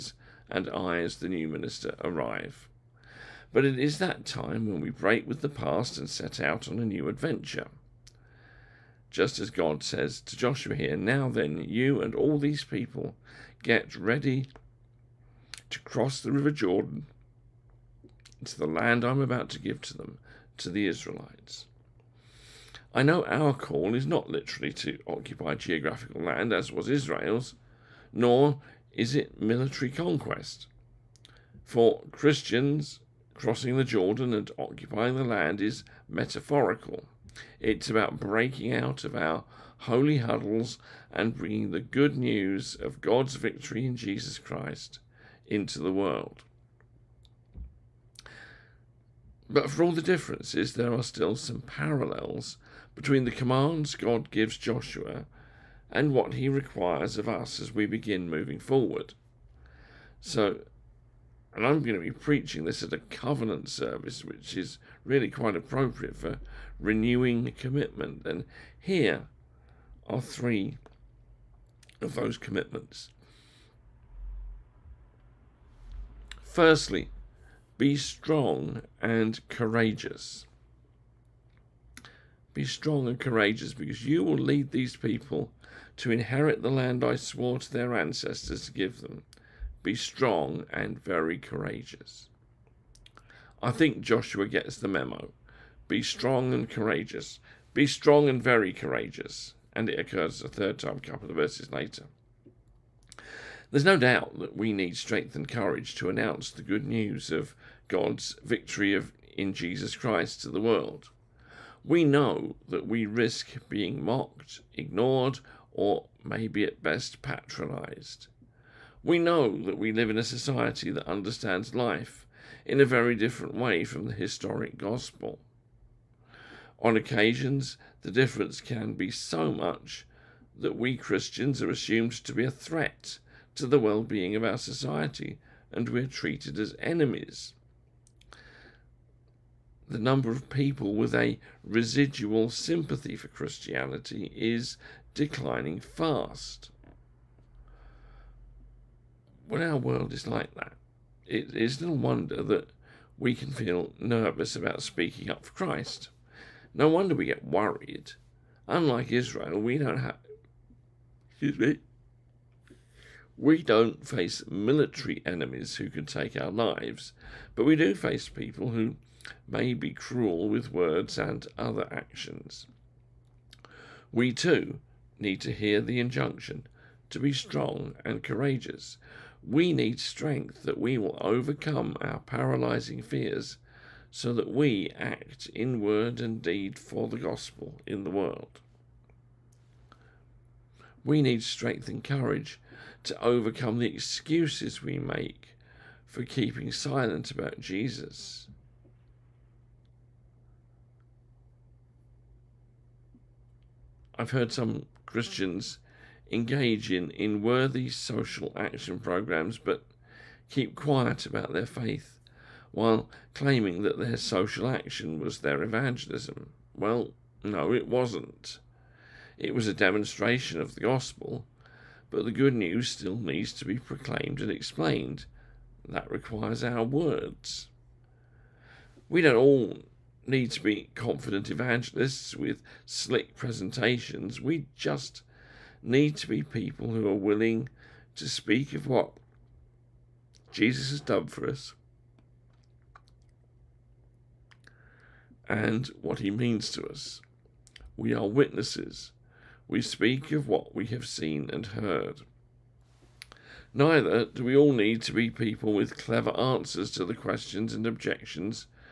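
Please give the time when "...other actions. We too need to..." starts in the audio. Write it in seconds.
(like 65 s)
171 s.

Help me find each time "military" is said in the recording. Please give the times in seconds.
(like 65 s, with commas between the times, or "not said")
29 s, 164 s.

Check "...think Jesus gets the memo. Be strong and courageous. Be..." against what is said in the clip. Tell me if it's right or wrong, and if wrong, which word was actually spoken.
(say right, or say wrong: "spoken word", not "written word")
wrong: "Joshua", not "Jesus".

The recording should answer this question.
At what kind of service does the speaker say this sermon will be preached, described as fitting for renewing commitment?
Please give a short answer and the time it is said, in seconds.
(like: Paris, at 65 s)
Covenant service, at 62 s.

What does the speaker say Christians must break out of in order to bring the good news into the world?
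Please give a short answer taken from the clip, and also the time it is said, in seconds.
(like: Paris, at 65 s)
Holy huddles, at 39 s.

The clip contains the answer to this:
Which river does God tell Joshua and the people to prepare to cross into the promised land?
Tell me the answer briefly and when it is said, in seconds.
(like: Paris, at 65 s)
River Jordan, at 16 s.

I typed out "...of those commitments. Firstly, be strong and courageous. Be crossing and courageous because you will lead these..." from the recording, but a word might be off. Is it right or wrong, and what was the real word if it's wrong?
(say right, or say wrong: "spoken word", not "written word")
wrong: "strong", not "crossing".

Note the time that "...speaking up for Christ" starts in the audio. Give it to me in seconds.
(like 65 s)
154 s.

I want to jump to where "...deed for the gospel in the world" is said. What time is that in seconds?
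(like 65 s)
186 s.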